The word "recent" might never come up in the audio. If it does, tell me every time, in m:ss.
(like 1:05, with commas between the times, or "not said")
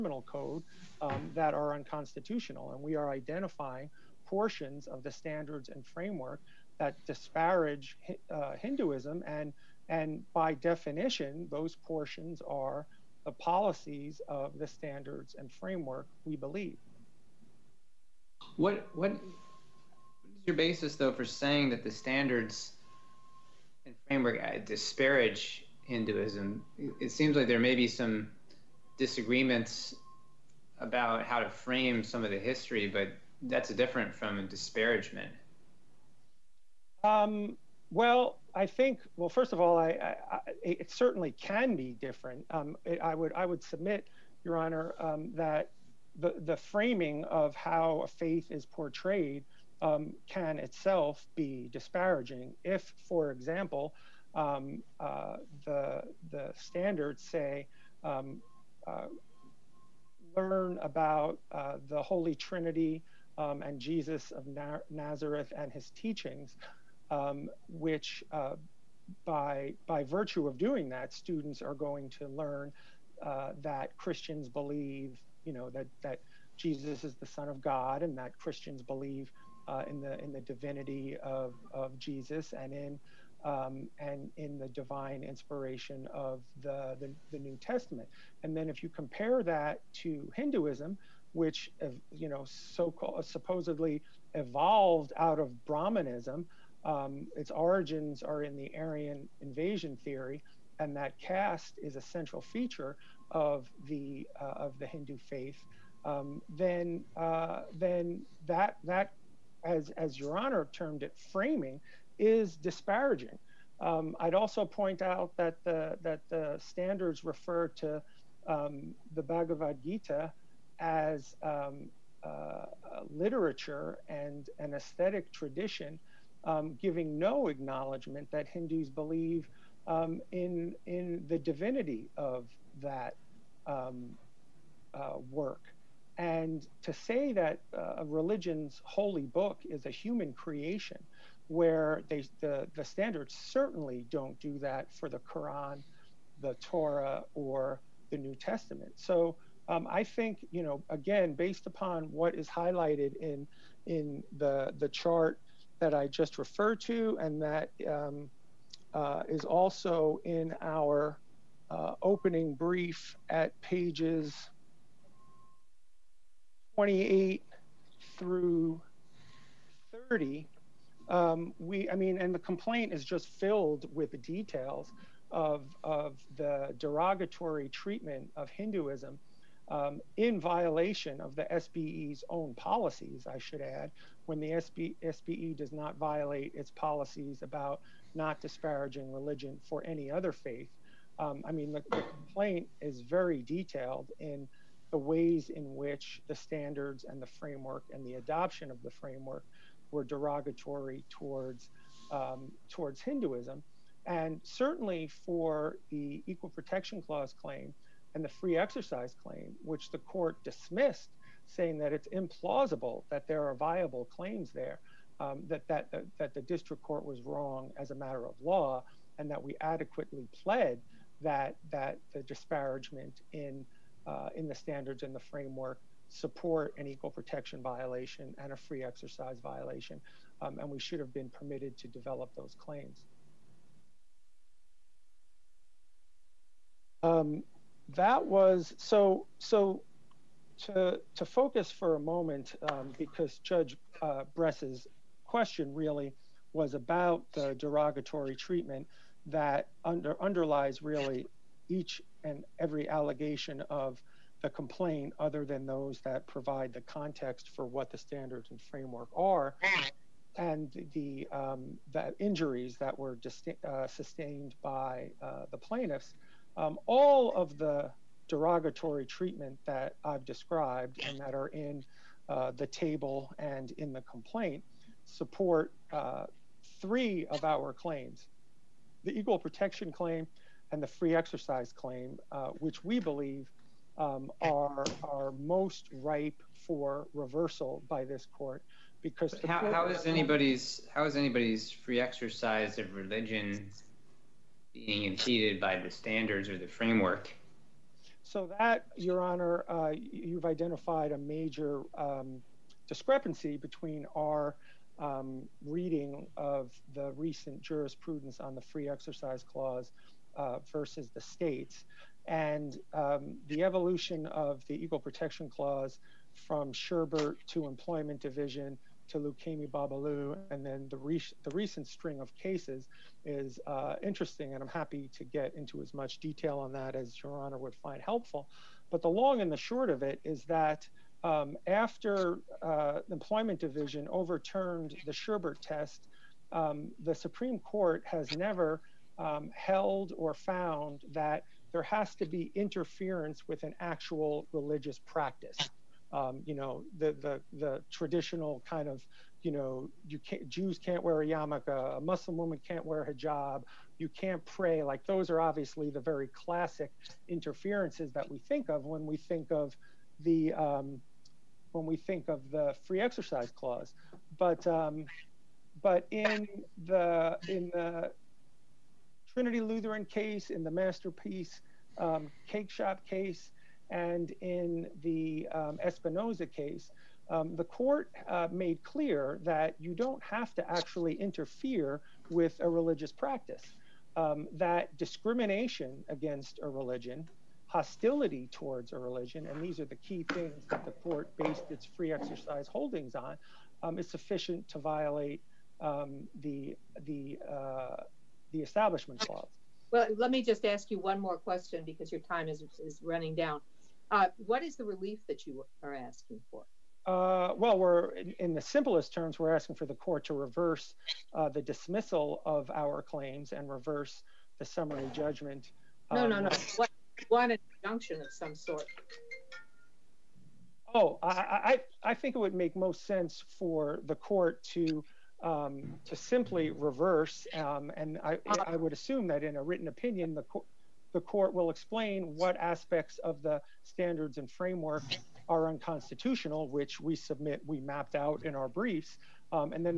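5:07, 5:21.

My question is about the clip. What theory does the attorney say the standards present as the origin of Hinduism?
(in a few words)
Aryan invasion theory.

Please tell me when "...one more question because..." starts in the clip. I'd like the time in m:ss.
6:40.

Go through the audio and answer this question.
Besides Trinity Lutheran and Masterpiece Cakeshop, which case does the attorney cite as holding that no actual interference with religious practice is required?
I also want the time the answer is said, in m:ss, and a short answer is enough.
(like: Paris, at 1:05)
Espinoza, at 6:15.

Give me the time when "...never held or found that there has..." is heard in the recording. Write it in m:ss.
5:38.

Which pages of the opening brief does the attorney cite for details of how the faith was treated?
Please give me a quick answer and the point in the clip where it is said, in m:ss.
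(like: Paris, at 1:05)
28 through 30, at 2:46.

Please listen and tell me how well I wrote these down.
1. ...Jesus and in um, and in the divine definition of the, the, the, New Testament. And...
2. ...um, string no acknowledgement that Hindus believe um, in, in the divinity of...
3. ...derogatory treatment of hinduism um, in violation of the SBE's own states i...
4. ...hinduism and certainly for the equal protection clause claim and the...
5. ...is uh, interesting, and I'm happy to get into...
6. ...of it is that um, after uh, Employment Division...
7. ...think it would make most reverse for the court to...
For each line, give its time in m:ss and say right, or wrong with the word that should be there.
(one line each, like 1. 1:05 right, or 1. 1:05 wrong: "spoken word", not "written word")
1. 1:21 wrong: "inspiration", not "definition"
2. 2:06 wrong: "giving", not "string"
3. 2:56 wrong: "policies", not "states"
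4. 3:22 right
5. 5:23 right
6. 5:29 right
7. 7:02 wrong: "sense", not "reverse".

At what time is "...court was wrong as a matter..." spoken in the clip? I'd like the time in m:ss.
3:36.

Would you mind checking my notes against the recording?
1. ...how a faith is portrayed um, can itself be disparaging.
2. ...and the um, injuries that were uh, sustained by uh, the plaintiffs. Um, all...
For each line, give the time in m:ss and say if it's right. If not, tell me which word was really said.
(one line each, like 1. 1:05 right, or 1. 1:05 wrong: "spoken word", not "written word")
1. 0:47 right
2. 4:20 right.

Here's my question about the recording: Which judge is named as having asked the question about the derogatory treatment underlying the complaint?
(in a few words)
Bress.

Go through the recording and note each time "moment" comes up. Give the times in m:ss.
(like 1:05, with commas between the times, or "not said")
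4:01.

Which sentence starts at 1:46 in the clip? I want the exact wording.
Um, then uh, then that that as as your honor termed it framing is disparaging.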